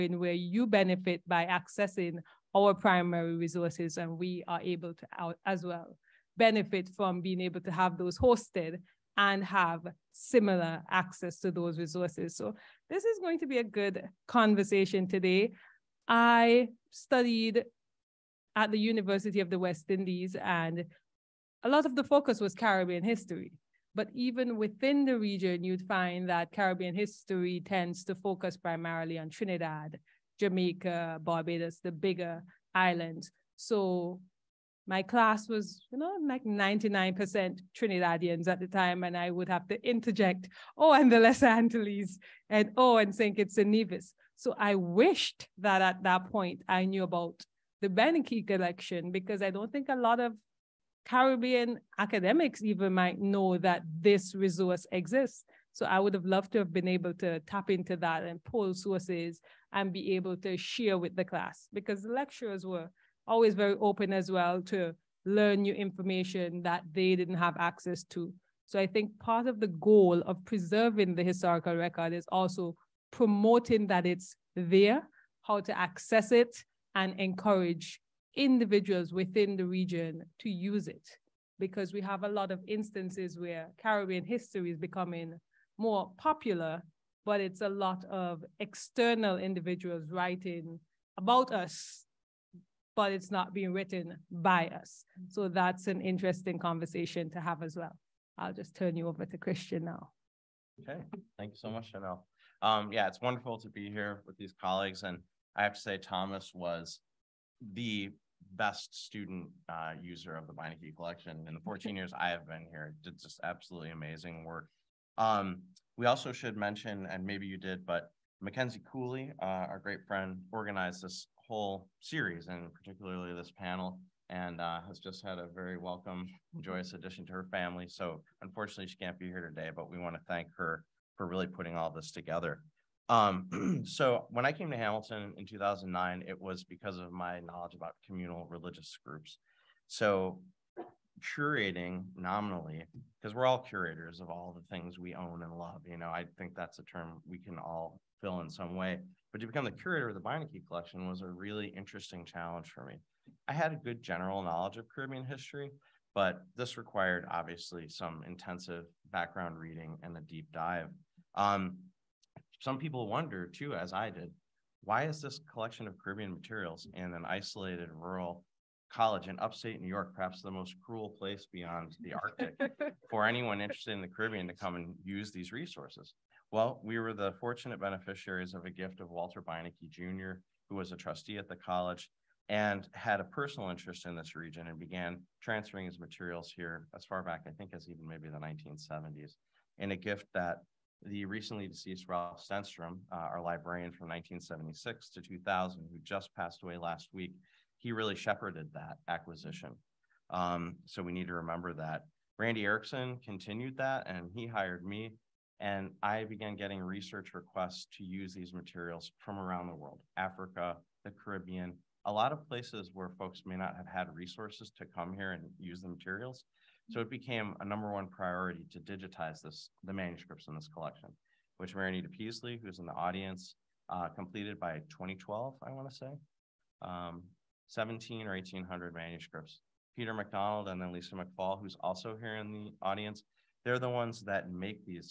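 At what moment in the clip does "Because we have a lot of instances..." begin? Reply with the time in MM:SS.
01:21.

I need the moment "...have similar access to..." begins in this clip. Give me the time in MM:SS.
00:09.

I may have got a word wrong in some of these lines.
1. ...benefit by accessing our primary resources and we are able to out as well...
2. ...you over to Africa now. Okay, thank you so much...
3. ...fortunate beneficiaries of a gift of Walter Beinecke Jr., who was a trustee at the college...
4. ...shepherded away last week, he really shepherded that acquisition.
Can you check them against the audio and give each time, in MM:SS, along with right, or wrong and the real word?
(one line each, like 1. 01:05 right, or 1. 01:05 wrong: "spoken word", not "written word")
1. 00:00 right
2. 01:38 wrong: "Christian", not "Africa"
3. 02:57 right
4. 03:16 wrong: "passed", not "shepherded".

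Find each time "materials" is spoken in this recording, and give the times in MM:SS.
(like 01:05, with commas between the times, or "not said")
02:46, 03:05, 03:28, 03:35.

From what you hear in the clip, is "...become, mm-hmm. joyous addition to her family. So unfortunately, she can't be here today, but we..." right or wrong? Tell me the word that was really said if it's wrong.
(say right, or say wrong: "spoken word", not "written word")
wrong: "welcome", not "become".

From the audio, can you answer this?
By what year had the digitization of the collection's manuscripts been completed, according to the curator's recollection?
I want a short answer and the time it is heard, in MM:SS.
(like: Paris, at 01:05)
2012, at 03:44.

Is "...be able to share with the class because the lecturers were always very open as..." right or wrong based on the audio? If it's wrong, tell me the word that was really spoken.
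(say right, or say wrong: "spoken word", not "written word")
right.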